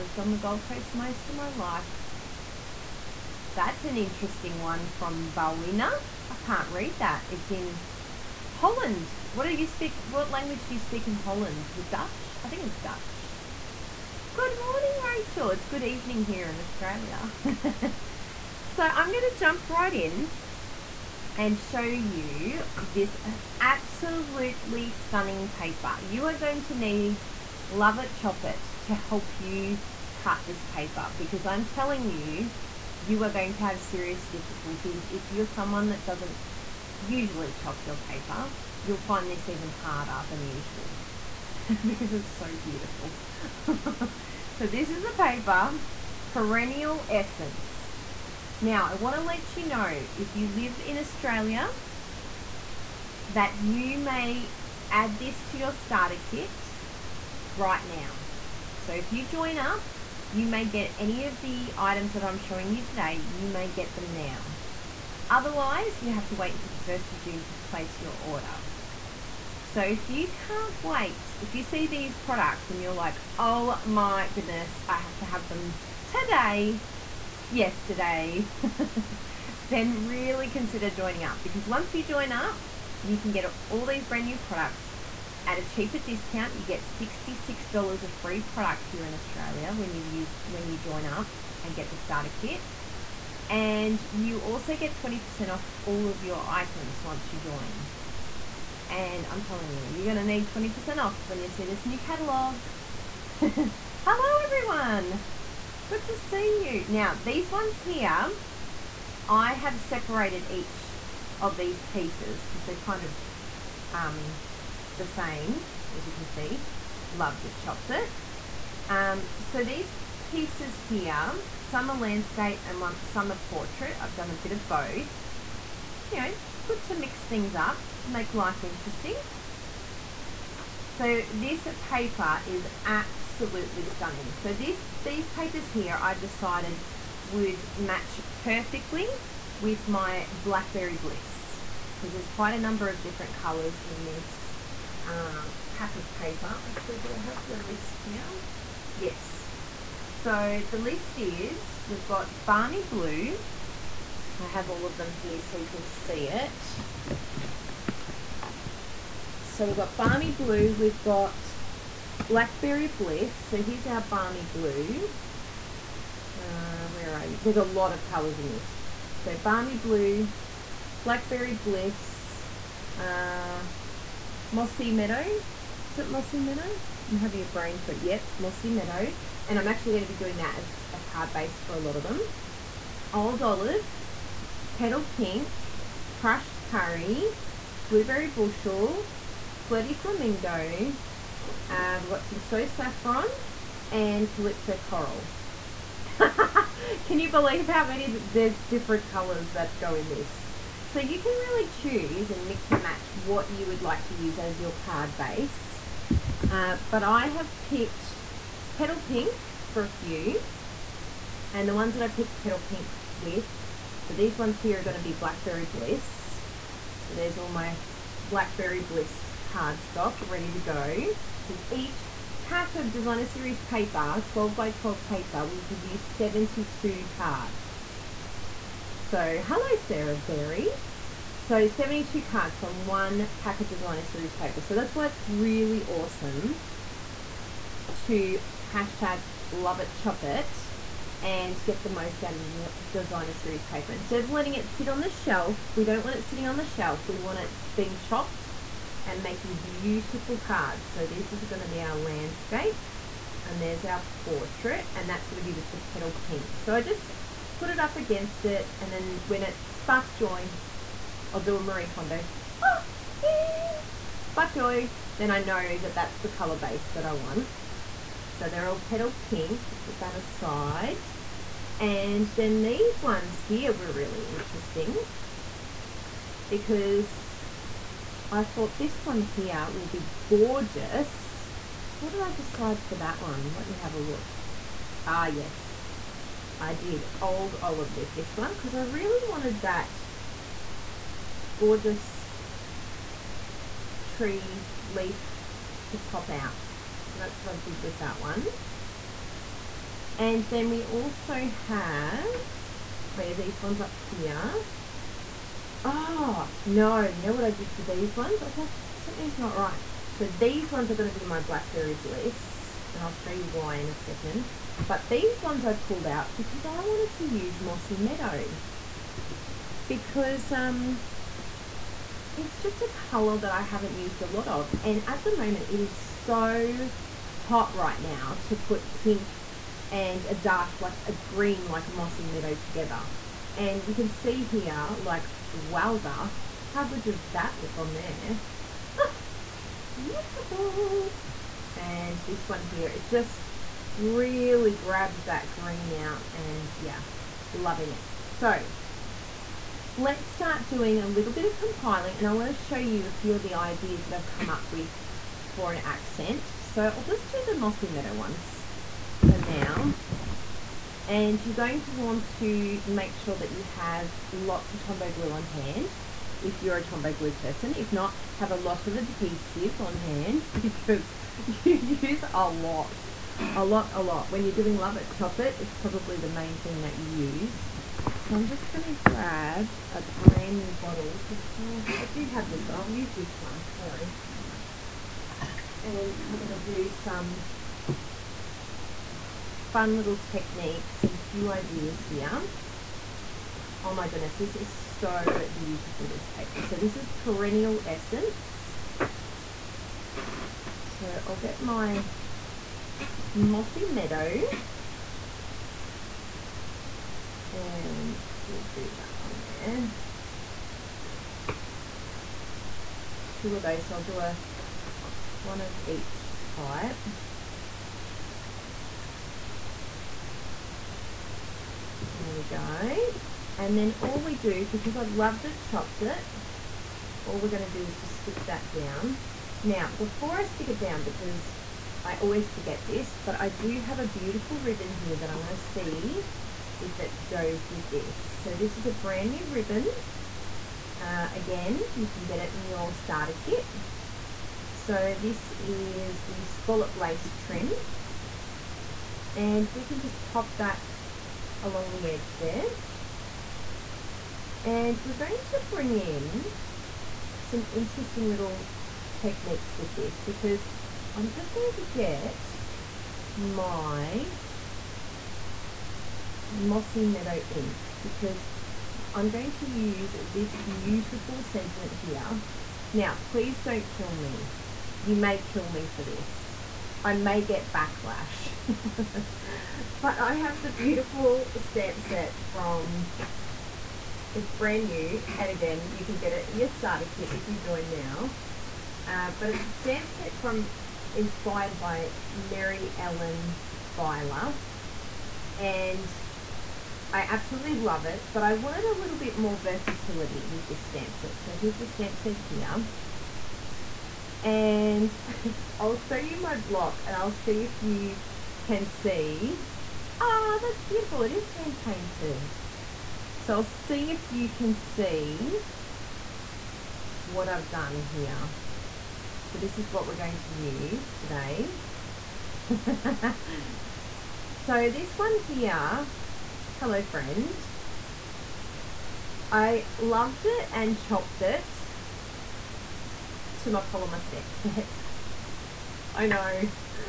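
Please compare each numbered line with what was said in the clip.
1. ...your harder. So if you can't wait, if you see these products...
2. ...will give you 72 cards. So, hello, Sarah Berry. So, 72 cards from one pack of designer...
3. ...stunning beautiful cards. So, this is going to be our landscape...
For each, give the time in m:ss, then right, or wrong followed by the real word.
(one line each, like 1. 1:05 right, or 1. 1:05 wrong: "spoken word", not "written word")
1. 1:08 wrong: "order", not "harder"
2. 3:45 right
3. 4:09 wrong: "making", not "stunning".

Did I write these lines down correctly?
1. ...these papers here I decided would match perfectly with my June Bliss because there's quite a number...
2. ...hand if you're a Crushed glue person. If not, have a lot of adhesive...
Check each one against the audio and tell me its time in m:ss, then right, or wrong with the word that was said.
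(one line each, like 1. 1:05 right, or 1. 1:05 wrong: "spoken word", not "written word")
1. 2:15 wrong: "Blackberry", not "June"
2. 6:05 wrong: "Tombow", not "Crushed".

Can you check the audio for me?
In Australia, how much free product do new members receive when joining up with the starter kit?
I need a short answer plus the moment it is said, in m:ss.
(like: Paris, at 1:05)
$66, at 1:26.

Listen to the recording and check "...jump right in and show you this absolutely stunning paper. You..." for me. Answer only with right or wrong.
right.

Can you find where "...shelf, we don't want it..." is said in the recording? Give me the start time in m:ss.
4:05.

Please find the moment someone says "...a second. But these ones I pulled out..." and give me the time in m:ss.
5:13.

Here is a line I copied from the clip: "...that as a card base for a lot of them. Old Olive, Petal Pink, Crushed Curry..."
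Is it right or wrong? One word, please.
right.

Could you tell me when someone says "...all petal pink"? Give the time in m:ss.
4:28.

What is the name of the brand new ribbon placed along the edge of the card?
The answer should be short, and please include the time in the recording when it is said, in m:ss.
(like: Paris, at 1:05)
Scallop lace trim, at 7:26.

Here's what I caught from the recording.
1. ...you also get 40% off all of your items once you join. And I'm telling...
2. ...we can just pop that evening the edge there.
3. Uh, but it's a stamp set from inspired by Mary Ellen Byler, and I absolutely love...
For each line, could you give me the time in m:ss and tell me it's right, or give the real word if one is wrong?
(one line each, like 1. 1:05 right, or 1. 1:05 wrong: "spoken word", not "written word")
1. 1:34 wrong: "20", not "40"
2. 7:29 wrong: "along", not "evening"
3. 8:09 right.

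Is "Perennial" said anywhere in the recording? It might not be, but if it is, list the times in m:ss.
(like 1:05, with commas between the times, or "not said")
0:46, 6:37.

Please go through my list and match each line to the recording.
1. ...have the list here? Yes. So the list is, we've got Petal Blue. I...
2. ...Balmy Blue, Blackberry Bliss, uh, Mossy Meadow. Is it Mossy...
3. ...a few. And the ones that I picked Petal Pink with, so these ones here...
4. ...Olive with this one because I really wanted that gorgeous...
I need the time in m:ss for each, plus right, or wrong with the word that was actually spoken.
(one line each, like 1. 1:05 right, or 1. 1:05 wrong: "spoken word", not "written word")
1. 2:27 wrong: "Balmy", not "Petal"
2. 2:49 right
3. 3:29 right
4. 4:47 right.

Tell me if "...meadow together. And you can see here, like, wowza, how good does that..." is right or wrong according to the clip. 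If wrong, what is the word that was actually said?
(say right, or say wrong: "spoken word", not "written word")
right.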